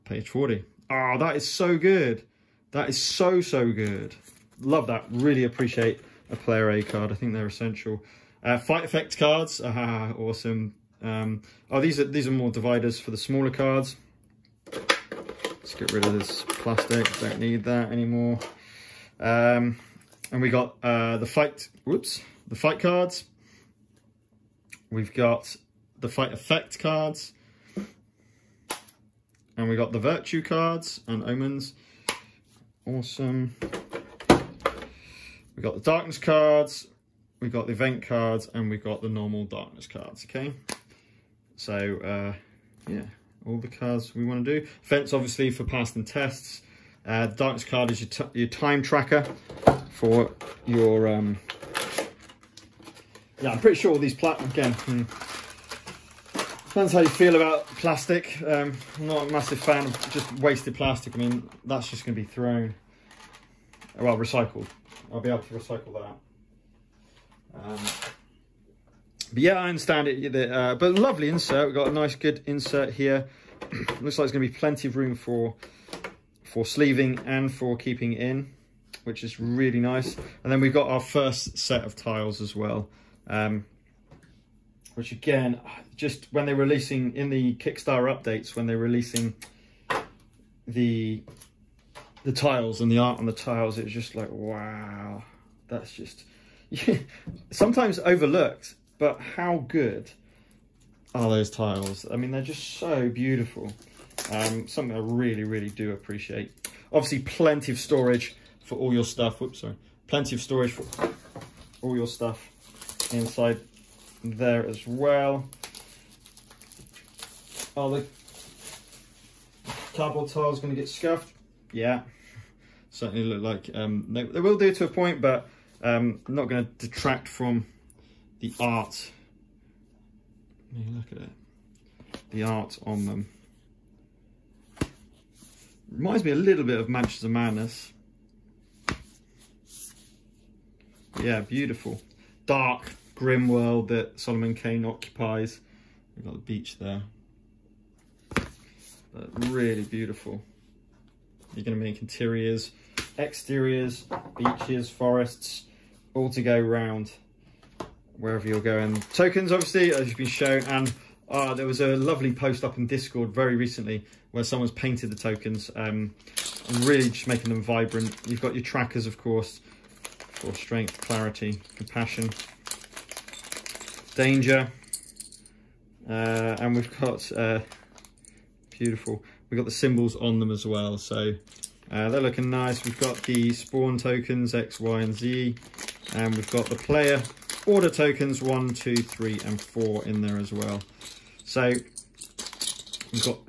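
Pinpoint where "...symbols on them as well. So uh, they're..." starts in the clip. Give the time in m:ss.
2:59.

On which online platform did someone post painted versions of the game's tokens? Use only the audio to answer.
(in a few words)
Discord.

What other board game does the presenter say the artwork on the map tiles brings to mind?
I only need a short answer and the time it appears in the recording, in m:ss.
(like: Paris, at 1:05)
Mansions of Madness, at 2:16.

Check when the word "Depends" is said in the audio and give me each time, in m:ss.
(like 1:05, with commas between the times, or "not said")
0:56.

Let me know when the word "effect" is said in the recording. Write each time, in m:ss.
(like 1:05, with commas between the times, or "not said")
0:08, 0:26.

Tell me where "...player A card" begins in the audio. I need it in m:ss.
0:06.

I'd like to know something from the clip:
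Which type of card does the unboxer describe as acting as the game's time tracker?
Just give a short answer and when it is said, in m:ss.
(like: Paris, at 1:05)
Darkness card, at 0:47.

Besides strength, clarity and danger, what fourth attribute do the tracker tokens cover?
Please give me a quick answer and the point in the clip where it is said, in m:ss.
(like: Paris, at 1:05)
Compassion, at 2:51.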